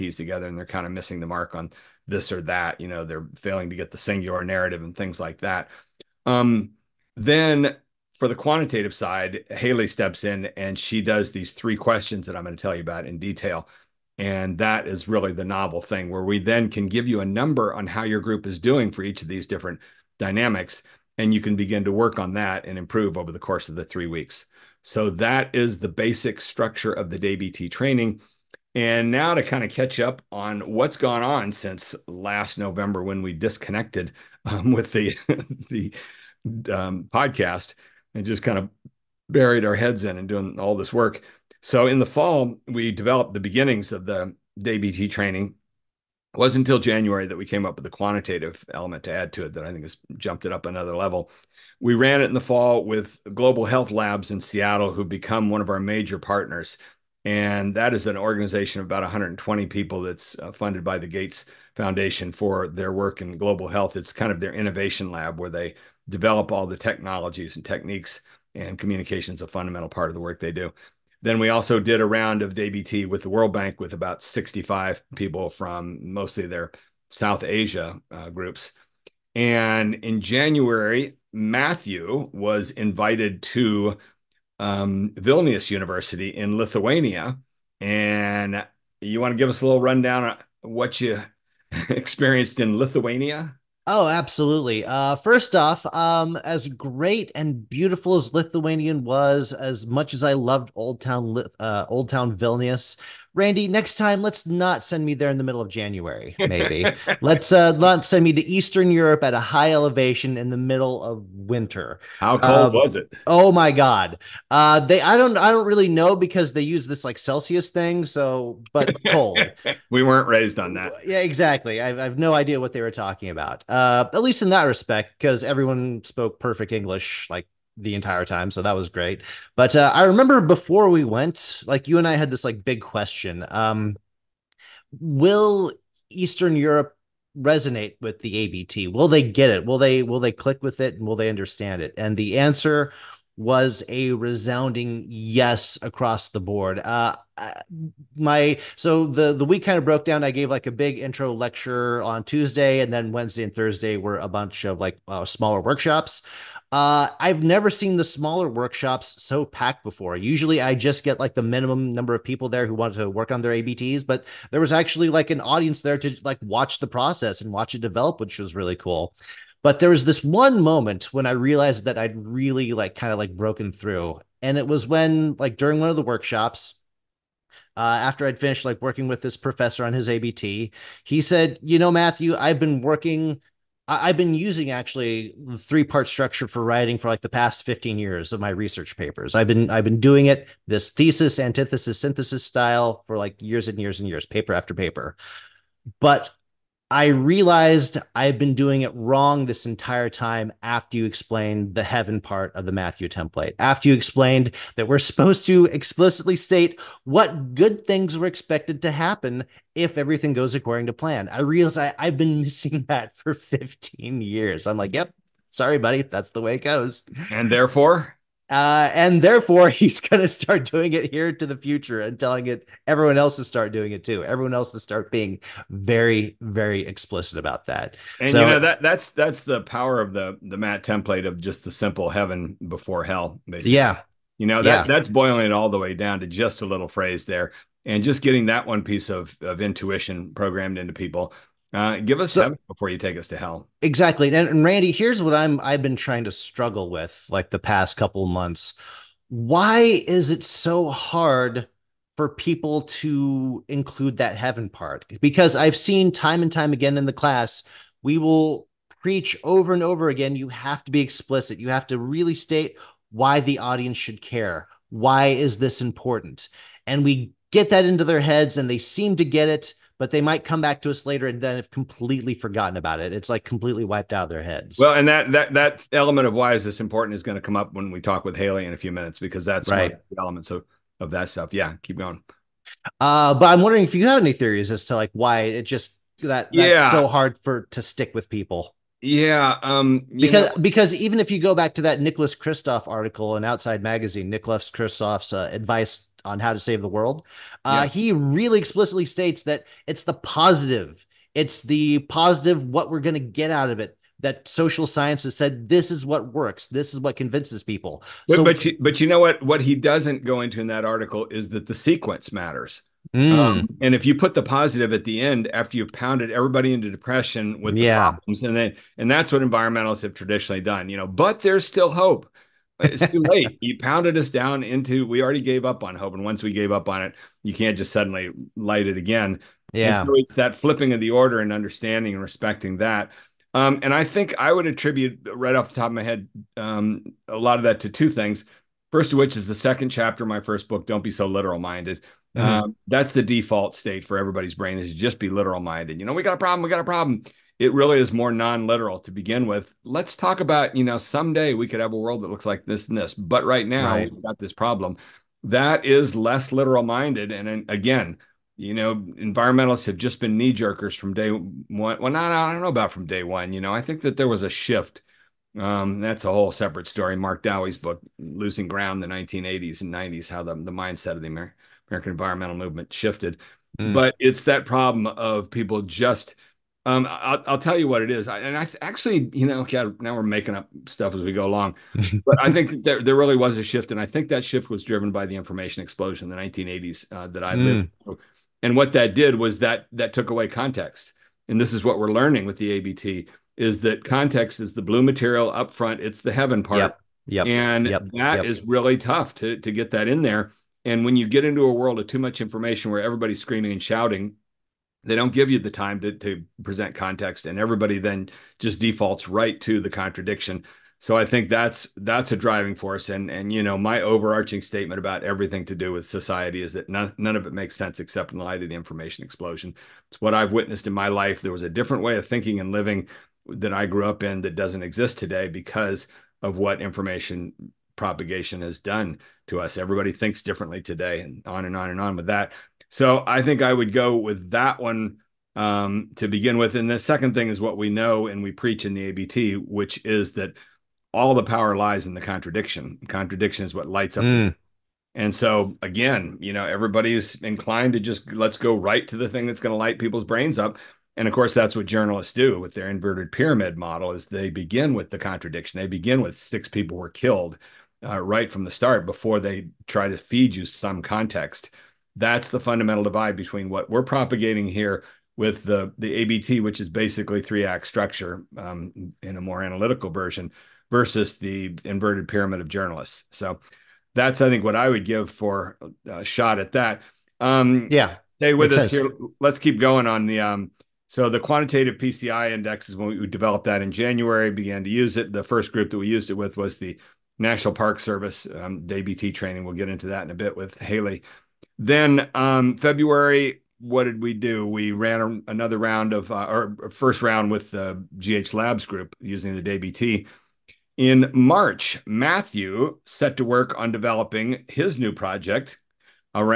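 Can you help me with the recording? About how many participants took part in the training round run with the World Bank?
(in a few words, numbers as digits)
65.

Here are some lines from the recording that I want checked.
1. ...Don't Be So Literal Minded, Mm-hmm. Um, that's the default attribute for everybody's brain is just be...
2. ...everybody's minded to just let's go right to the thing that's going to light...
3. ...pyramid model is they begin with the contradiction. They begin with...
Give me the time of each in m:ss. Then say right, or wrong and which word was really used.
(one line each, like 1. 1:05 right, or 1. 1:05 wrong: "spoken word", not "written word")
1. 5:40 wrong: "state", not "attribute"
2. 7:26 wrong: "inclined", not "minded"
3. 7:33 right.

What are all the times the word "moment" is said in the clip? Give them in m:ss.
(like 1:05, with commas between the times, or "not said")
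2:50.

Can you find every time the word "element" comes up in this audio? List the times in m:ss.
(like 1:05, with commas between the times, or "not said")
0:48, 4:35, 4:40.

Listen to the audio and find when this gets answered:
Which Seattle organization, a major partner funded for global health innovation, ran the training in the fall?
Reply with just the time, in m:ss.
0:53.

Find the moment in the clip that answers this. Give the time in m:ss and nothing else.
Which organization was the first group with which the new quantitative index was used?
8:07.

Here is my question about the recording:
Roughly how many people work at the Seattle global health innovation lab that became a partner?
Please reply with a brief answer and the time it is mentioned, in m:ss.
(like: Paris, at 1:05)
120, at 0:59.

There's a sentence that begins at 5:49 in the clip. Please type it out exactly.
Let's talk about, you know, someday we could have a world that looks like this and this, but right now right.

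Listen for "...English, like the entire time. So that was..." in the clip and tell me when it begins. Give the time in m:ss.
2:06.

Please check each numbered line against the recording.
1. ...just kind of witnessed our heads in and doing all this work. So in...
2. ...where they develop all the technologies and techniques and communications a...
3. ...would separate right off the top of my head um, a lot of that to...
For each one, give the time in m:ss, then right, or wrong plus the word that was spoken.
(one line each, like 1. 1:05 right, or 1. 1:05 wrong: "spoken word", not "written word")
1. 0:38 wrong: "buried", not "witnessed"
2. 1:05 right
3. 5:34 wrong: "attribute", not "separate".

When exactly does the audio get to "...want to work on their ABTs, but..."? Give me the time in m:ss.
2:42.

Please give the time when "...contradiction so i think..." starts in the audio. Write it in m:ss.
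6:49.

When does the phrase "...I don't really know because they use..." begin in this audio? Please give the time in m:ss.
1:55.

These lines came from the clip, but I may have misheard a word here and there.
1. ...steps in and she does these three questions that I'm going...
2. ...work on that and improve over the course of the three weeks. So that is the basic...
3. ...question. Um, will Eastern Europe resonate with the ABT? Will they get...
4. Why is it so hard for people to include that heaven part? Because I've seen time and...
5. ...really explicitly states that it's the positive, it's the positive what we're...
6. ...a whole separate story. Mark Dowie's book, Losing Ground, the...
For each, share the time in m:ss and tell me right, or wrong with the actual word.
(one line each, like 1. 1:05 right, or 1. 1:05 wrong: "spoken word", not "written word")
1. 0:09 right
2. 0:21 right
3. 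2:12 right
4. 4:09 right
5. 4:58 right
6. 6:06 right.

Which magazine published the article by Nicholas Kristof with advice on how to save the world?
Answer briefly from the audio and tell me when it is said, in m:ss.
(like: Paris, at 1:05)
Outside Magazine, at 4:53.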